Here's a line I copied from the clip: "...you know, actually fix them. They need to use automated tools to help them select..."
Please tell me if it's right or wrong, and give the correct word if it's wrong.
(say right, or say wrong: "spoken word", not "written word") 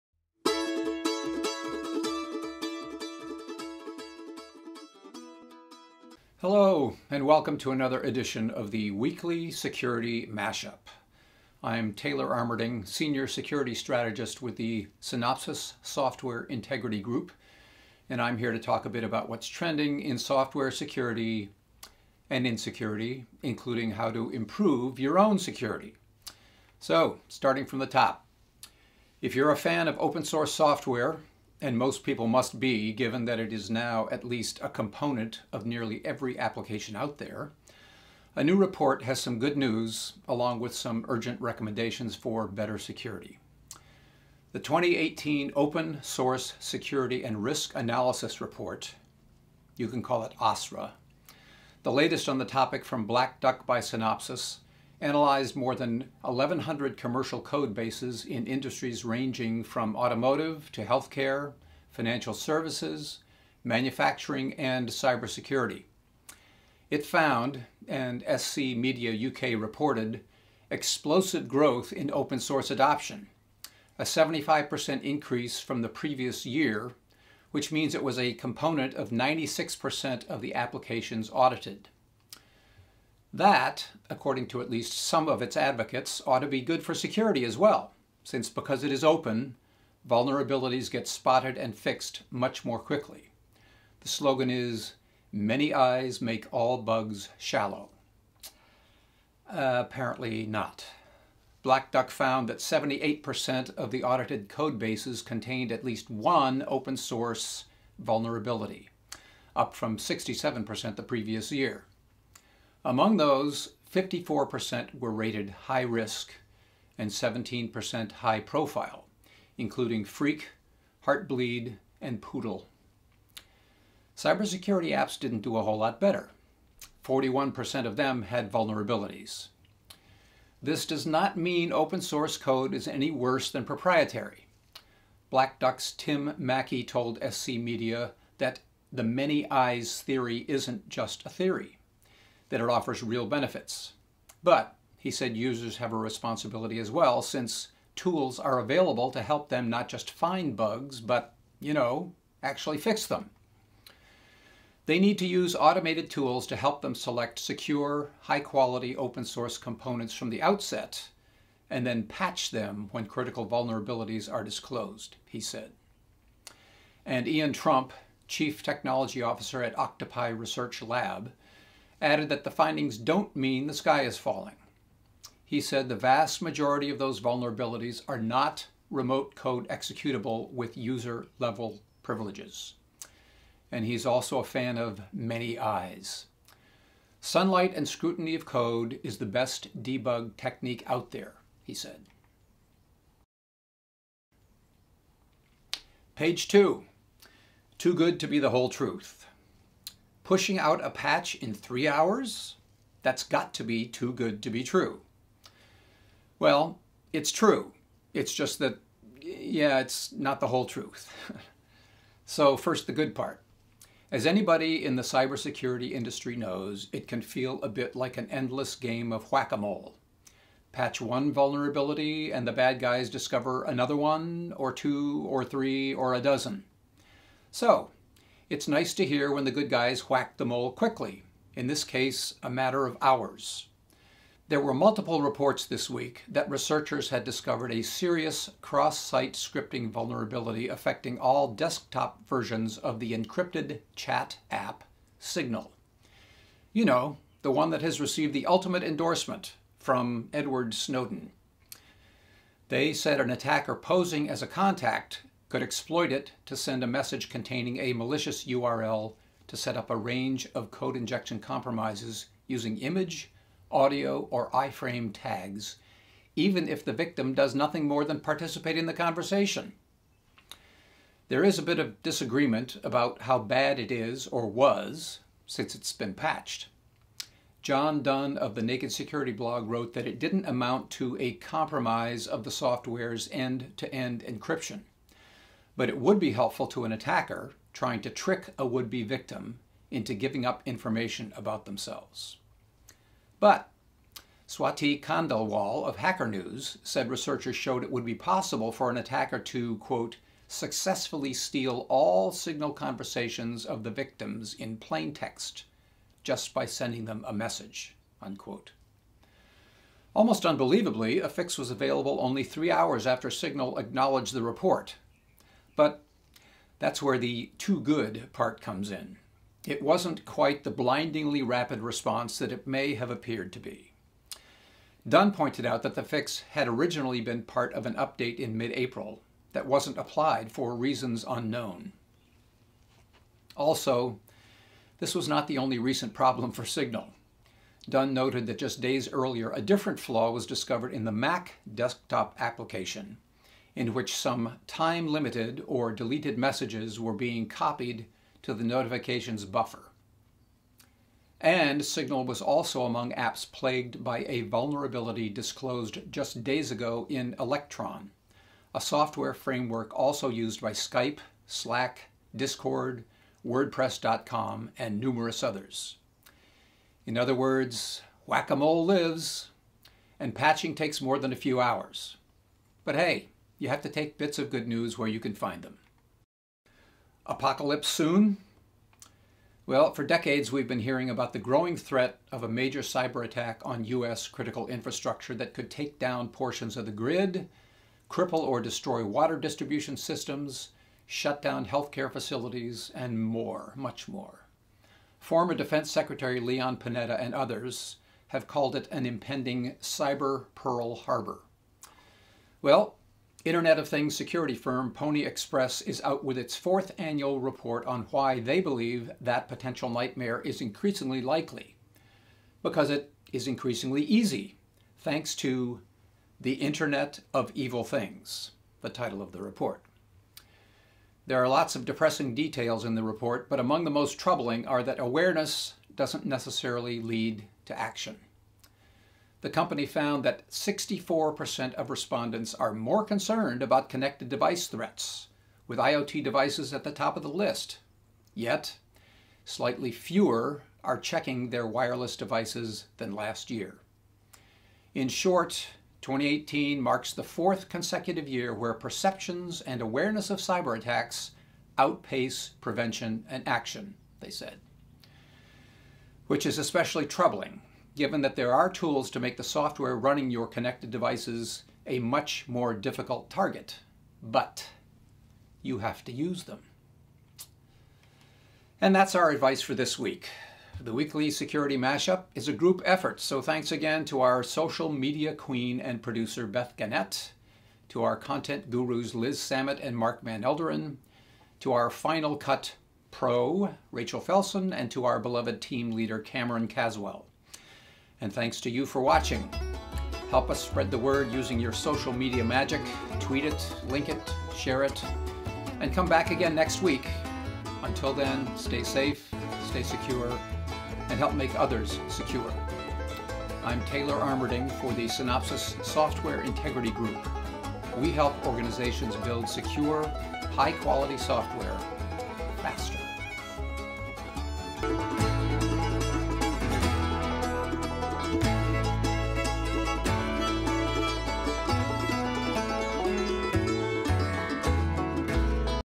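right.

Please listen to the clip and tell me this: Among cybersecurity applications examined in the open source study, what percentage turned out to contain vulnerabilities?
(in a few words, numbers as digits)
41%.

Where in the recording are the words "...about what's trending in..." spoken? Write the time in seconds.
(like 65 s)
19 s.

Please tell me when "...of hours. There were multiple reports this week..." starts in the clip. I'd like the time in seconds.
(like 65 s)
232 s.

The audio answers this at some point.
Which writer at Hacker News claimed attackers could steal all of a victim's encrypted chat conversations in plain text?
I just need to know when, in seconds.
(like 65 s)
294 s.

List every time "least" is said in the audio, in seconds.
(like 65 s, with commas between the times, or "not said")
34 s, 84 s, 105 s.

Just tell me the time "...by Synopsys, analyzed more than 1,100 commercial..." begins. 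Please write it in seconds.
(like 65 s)
53 s.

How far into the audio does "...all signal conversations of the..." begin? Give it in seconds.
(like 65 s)
301 s.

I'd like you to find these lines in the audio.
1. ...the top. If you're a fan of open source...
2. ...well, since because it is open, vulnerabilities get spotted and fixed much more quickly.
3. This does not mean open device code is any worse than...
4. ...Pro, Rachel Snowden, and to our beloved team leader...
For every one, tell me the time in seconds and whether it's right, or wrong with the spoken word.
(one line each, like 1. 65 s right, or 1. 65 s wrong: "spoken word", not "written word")
1. 27 s right
2. 87 s right
3. 130 s wrong: "source", not "device"
4. 483 s wrong: "Felson", not "Snowden".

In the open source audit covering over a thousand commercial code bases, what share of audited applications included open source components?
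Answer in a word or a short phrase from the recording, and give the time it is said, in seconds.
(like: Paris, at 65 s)
96%, at 79 s.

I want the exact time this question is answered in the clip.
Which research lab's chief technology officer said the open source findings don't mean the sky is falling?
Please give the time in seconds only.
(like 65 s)
169 s.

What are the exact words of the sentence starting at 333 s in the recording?
Also, this was not the only recent problem for Signal.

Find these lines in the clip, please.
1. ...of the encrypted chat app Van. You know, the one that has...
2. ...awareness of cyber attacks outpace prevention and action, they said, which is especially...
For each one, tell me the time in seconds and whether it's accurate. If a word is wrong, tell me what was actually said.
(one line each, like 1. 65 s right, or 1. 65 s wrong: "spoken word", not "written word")
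1. 242 s wrong: "Signal", not "Van"
2. 449 s right.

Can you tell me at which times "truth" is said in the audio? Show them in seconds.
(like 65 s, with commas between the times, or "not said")
198 s, 210 s.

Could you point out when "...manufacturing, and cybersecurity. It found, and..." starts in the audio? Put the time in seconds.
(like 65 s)
63 s.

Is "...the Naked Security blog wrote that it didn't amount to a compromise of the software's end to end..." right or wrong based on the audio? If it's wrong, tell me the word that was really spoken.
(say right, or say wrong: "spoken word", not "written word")
right.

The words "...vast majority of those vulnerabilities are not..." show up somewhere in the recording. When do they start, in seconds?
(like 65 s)
175 s.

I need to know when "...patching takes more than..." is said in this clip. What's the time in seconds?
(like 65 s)
370 s.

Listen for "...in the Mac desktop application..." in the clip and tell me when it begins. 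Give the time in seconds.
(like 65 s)
340 s.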